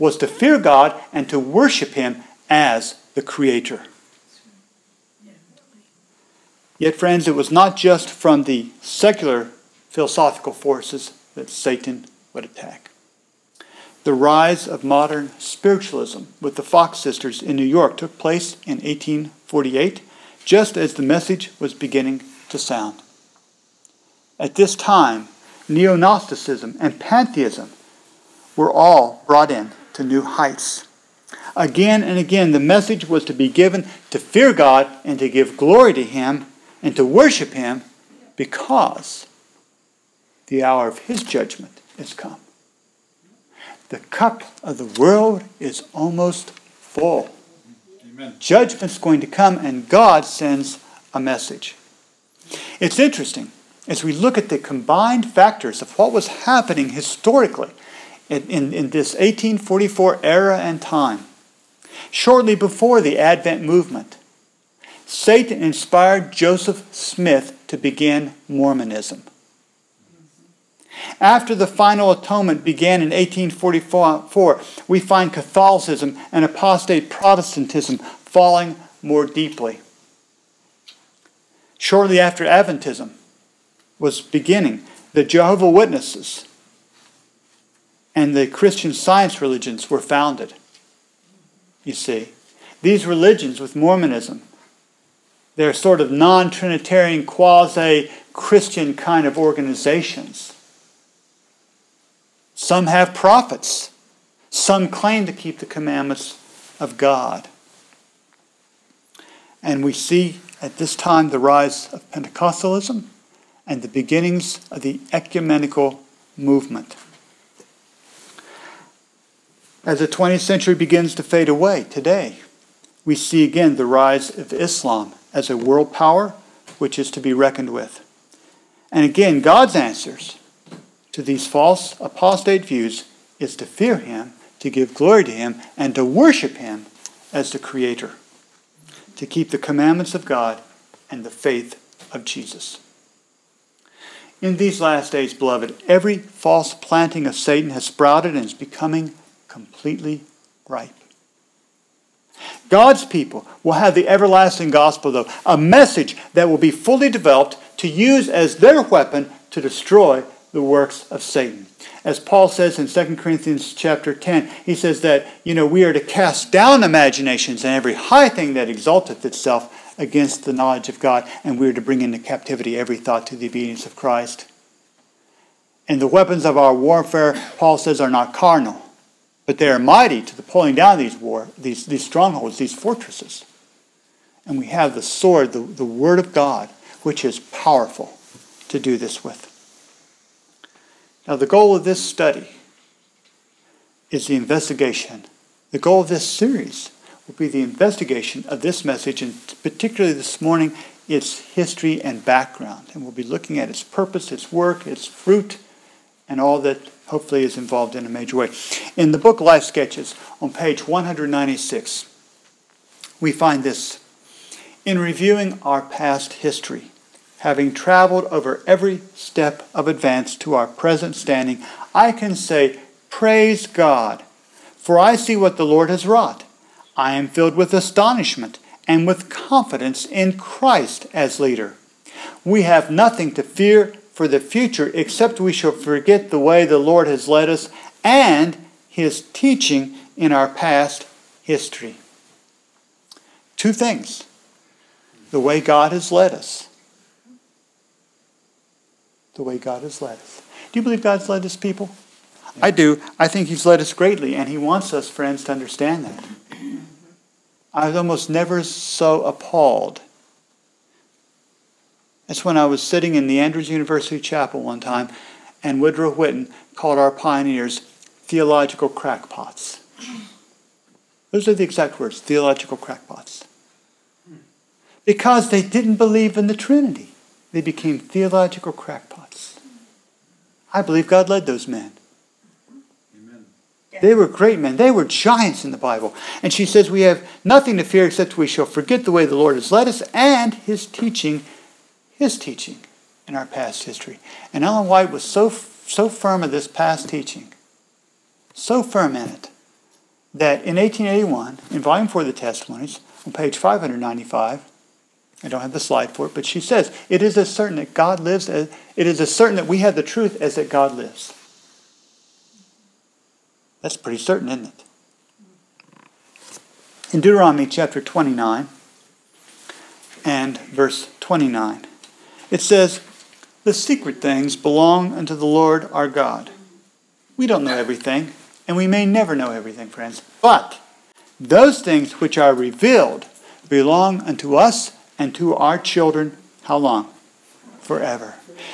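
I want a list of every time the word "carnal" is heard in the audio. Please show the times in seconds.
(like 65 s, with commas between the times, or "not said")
178 s.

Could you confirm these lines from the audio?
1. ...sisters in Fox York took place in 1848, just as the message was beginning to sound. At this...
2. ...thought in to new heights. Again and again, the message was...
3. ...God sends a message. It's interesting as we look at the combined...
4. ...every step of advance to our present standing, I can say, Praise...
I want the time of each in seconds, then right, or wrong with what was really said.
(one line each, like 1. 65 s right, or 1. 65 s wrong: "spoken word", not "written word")
1. 16 s wrong: "New", not "Fox"
2. 29 s wrong: "brought", not "thought"
3. 49 s right
4. 218 s right.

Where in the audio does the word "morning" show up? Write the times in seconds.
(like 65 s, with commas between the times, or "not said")
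200 s.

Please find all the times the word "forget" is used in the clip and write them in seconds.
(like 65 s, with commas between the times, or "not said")
235 s, 288 s.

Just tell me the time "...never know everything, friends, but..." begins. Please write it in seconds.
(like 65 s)
329 s.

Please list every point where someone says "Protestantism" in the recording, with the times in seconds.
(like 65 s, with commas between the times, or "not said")
77 s.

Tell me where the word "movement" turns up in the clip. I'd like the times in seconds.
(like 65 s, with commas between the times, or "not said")
63 s, 116 s.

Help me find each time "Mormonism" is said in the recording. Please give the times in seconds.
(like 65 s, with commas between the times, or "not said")
68 s, 93 s.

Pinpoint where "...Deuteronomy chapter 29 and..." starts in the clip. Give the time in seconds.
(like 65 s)
317 s.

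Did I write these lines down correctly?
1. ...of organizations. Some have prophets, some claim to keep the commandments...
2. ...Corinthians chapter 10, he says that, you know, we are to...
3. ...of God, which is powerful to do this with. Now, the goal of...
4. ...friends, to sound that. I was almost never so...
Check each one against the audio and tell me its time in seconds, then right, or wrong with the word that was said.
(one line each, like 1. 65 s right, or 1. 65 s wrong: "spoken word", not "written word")
1. 99 s right
2. 163 s right
3. 186 s right
4. 255 s wrong: "understand", not "sound".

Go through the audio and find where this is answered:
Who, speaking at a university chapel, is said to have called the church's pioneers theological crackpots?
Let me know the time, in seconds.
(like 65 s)
265 s.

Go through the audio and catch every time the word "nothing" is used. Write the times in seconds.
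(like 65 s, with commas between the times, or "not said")
232 s, 287 s.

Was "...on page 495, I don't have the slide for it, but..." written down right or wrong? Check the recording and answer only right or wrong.
wrong.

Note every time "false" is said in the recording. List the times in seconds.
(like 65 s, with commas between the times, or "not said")
131 s, 146 s.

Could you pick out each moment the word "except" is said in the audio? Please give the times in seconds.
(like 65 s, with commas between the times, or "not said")
234 s, 288 s.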